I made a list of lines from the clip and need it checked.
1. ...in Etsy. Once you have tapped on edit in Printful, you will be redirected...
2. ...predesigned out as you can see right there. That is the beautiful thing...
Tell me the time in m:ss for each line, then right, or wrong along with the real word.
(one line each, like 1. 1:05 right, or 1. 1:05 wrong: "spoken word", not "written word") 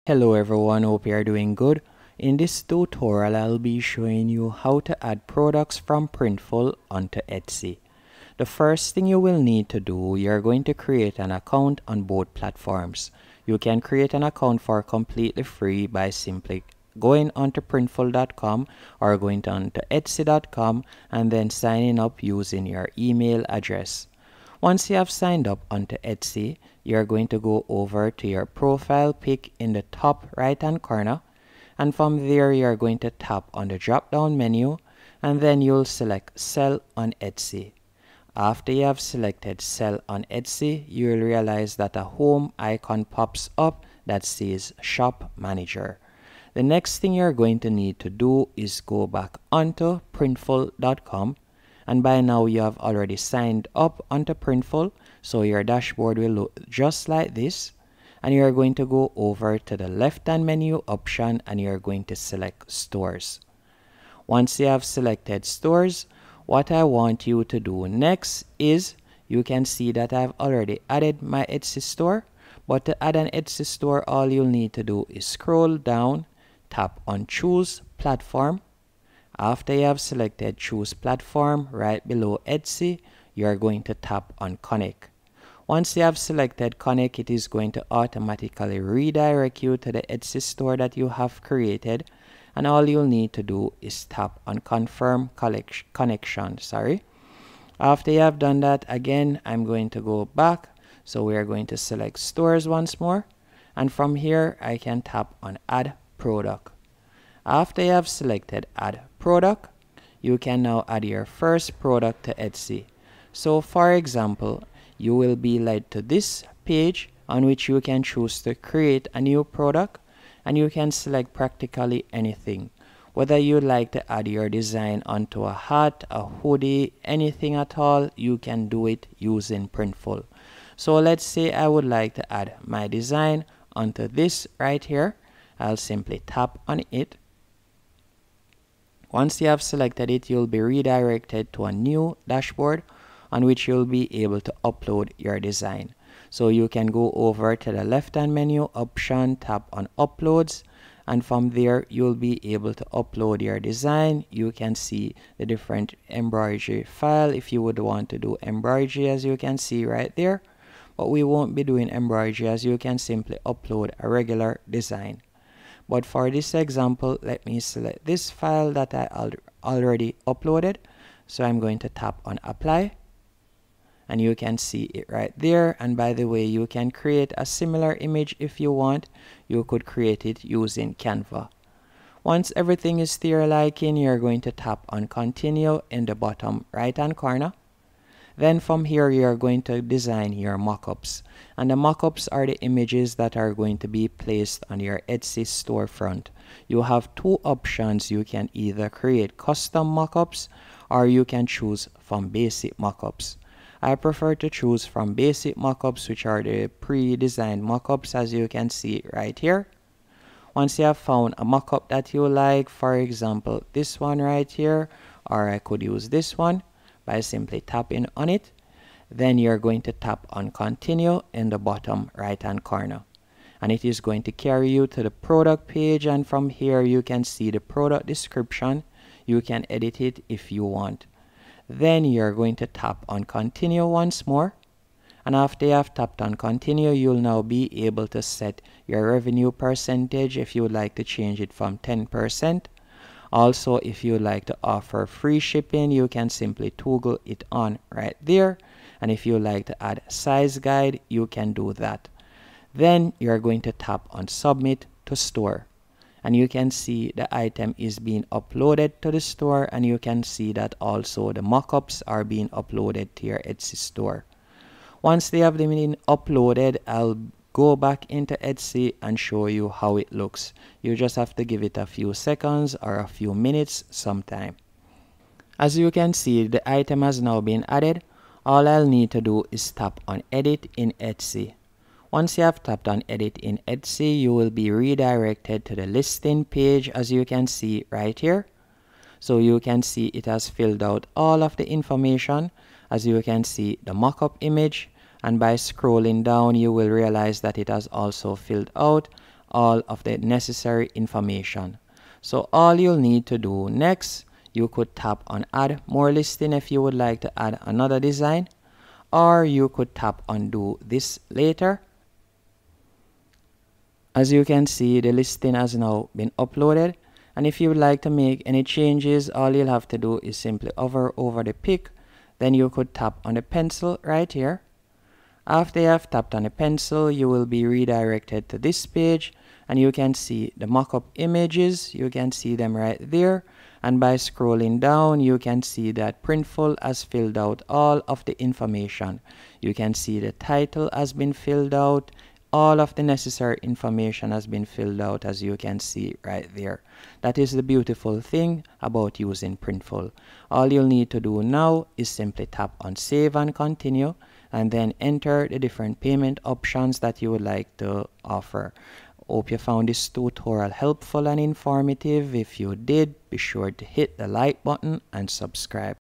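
1. 4:40 wrong: "Etsy", not "Printful"
2. 5:44 wrong: "filled", not "predesigned".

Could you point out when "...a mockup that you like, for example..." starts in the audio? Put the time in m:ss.
3:31.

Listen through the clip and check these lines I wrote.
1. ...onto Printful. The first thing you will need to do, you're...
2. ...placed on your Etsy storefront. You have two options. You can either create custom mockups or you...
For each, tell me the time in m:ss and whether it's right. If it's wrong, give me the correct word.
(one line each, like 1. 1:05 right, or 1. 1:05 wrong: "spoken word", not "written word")
1. 0:06 wrong: "Etsy", not "Printful"
2. 3:14 right.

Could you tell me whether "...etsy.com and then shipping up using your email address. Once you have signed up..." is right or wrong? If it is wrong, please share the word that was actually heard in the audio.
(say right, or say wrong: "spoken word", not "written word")
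wrong: "signing", not "shipping".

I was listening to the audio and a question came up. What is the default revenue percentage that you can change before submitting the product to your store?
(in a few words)
10%.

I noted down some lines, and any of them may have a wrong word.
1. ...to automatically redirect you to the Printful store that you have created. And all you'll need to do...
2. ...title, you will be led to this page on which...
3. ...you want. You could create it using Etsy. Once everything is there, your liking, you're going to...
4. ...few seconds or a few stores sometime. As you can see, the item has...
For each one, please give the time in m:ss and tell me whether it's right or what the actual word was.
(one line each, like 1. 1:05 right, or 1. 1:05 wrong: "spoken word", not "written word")
1. 1:27 wrong: "Etsy", not "Printful"
2. 1:53 wrong: "example", not "title"
3. 2:58 wrong: "Canva", not "Etsy"
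4. 4:31 wrong: "minutes", not "stores".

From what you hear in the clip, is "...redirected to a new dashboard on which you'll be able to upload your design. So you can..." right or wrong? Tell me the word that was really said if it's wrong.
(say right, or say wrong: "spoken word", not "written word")
right.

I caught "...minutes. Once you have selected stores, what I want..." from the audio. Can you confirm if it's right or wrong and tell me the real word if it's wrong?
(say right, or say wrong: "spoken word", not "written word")
wrong: "stores", not "minutes".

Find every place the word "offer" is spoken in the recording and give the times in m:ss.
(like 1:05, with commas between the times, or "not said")
4:04, 5:58.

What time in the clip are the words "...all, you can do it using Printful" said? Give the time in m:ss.
2:07.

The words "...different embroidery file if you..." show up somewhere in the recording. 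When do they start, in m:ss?
2:35.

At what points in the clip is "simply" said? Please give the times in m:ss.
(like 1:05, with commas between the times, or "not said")
0:16, 2:15, 2:42, 3:37, 4:06, 5:20, 5:52.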